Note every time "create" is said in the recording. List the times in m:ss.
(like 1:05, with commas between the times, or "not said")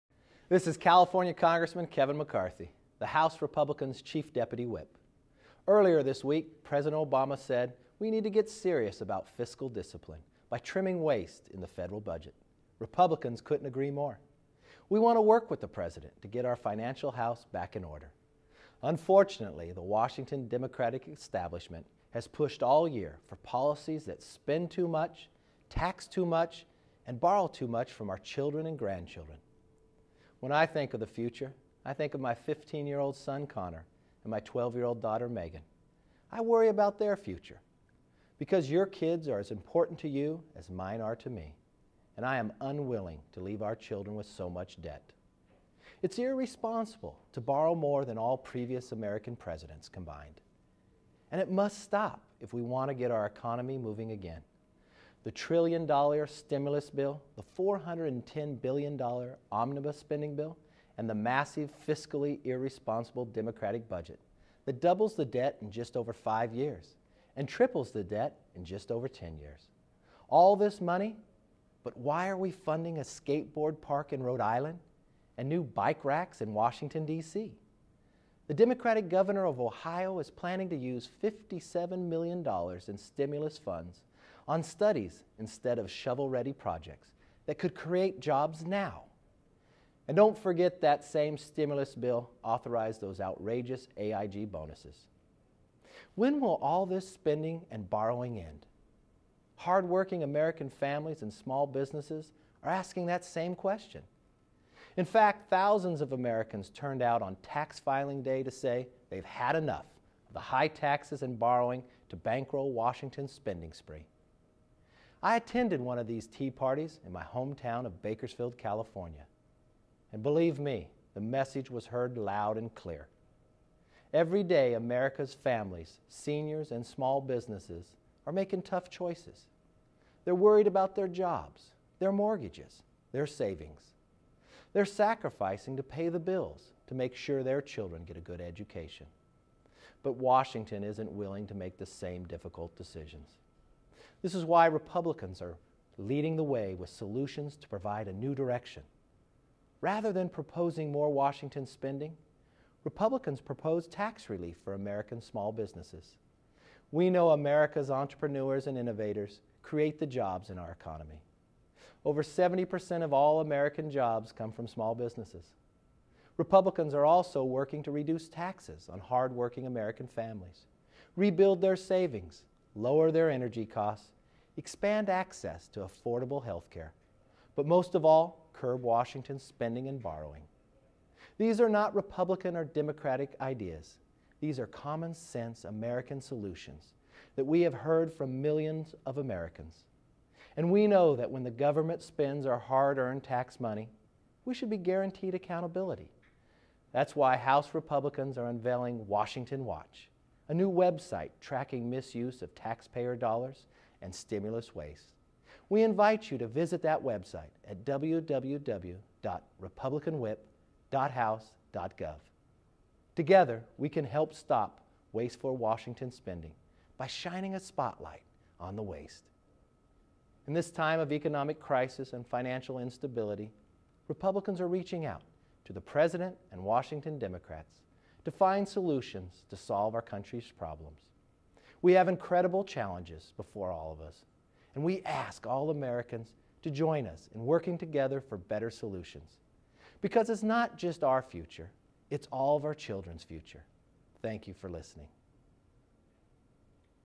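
1:27, 2:39.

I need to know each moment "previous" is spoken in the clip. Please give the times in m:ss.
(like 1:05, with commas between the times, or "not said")
0:48.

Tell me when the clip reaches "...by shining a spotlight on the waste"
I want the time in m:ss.
3:36.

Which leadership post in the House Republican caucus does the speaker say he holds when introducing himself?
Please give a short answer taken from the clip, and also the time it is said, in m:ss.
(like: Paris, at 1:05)
chief deputy whip, at 0:04.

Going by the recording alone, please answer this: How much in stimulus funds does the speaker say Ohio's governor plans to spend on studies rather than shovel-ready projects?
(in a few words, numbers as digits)
$57 million.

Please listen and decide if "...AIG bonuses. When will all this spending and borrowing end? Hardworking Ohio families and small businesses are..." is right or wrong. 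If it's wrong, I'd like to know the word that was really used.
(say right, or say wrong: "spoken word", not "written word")
wrong: "American", not "Ohio".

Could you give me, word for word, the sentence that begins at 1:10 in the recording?
All this money, but why are we funding a skateboard park in Rhode Island and new bike racks in Washington, D.C.?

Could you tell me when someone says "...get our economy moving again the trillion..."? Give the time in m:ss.
0:52.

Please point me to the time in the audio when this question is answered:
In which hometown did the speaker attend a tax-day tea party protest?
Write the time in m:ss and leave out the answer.
1:58.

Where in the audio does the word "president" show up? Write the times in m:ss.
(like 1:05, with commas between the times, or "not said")
0:06, 0:15, 0:49, 3:45.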